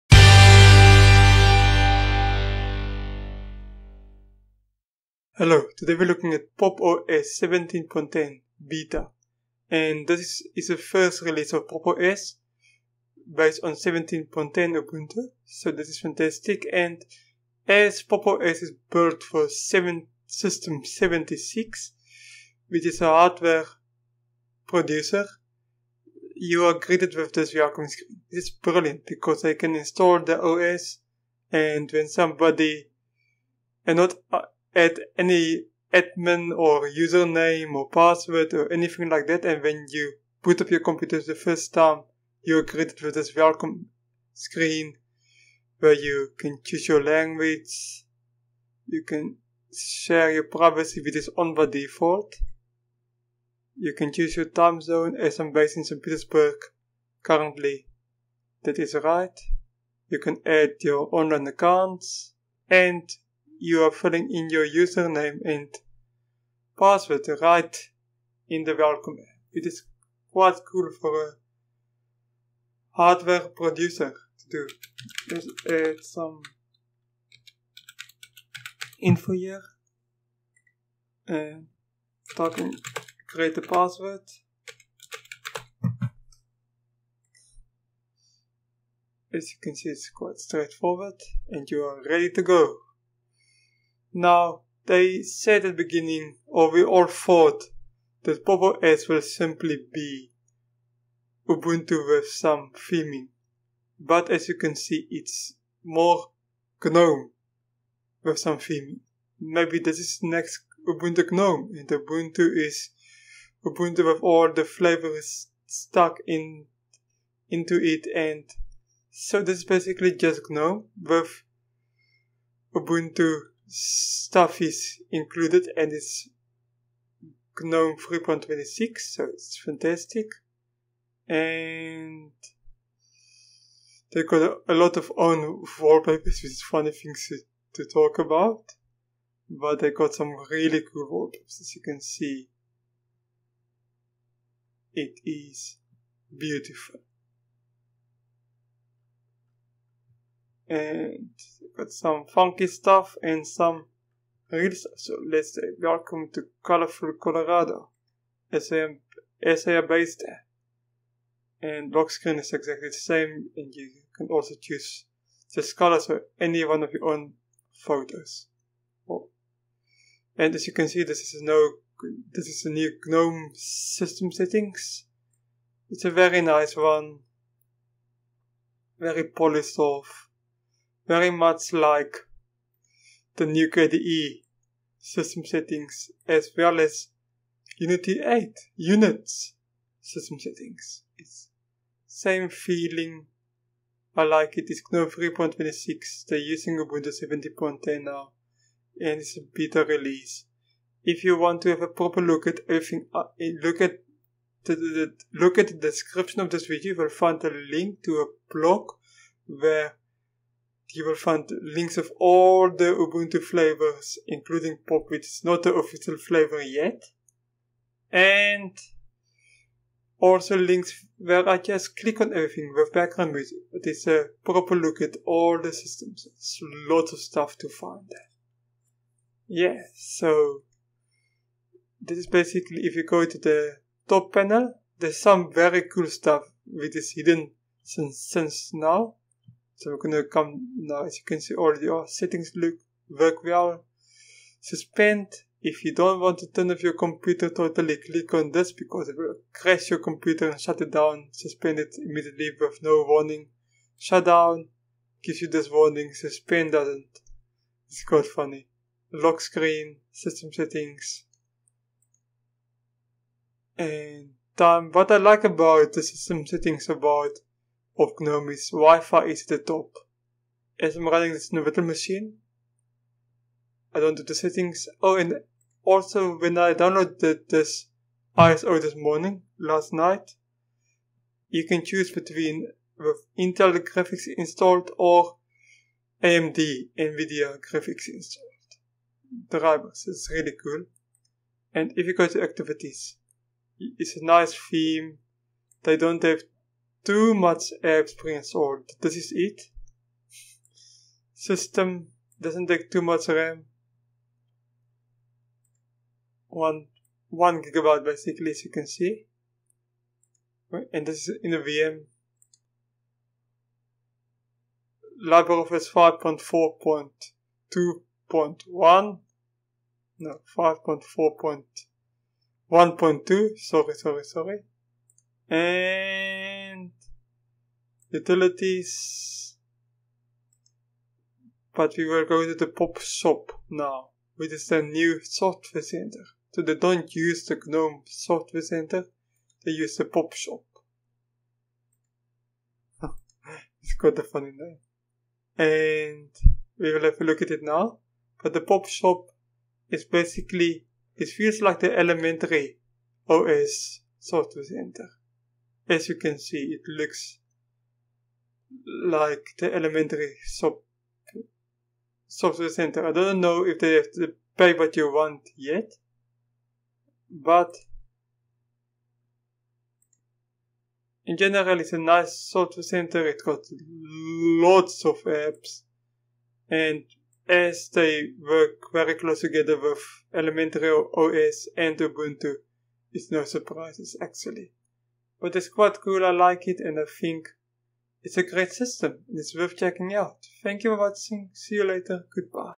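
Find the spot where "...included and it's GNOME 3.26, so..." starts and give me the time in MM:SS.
02:05.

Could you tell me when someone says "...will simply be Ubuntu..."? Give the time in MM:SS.
01:39.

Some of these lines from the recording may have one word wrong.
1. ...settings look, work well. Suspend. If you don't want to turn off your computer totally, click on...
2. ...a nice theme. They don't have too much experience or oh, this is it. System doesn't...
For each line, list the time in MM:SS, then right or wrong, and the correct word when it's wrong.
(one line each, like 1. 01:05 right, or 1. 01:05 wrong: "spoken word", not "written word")
1. 04:02 right
2. 04:54 right.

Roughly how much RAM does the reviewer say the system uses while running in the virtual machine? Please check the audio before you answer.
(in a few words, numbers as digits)
1 gigabyte.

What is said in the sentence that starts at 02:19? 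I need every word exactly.
But they got some really cool wallpapers, as you can see.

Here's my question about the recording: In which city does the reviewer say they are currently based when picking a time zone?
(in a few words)
St. Petersburg.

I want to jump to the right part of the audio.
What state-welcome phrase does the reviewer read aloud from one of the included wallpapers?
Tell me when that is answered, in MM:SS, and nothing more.
02:36.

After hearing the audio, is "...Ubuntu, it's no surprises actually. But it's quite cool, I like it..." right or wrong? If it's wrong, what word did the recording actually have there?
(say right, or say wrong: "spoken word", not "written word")
right.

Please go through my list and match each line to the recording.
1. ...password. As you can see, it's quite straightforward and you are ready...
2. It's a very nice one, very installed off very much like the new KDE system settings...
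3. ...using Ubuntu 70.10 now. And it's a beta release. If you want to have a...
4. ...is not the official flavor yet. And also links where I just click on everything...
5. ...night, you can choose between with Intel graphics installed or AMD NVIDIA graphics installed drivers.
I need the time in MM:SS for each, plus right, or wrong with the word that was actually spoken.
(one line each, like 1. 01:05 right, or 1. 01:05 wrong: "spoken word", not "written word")
1. 01:23 right
2. 02:55 wrong: "polished", not "installed"
3. 03:16 right
4. 03:35 right
5. 04:39 right.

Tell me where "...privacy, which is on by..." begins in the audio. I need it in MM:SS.
00:50.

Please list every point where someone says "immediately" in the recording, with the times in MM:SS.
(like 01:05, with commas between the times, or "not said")
04:11.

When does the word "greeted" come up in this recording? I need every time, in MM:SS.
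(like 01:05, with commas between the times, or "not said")
00:26, 00:42.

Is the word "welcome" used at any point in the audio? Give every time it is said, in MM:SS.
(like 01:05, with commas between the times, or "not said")
00:27, 00:43, 01:08, 02:35.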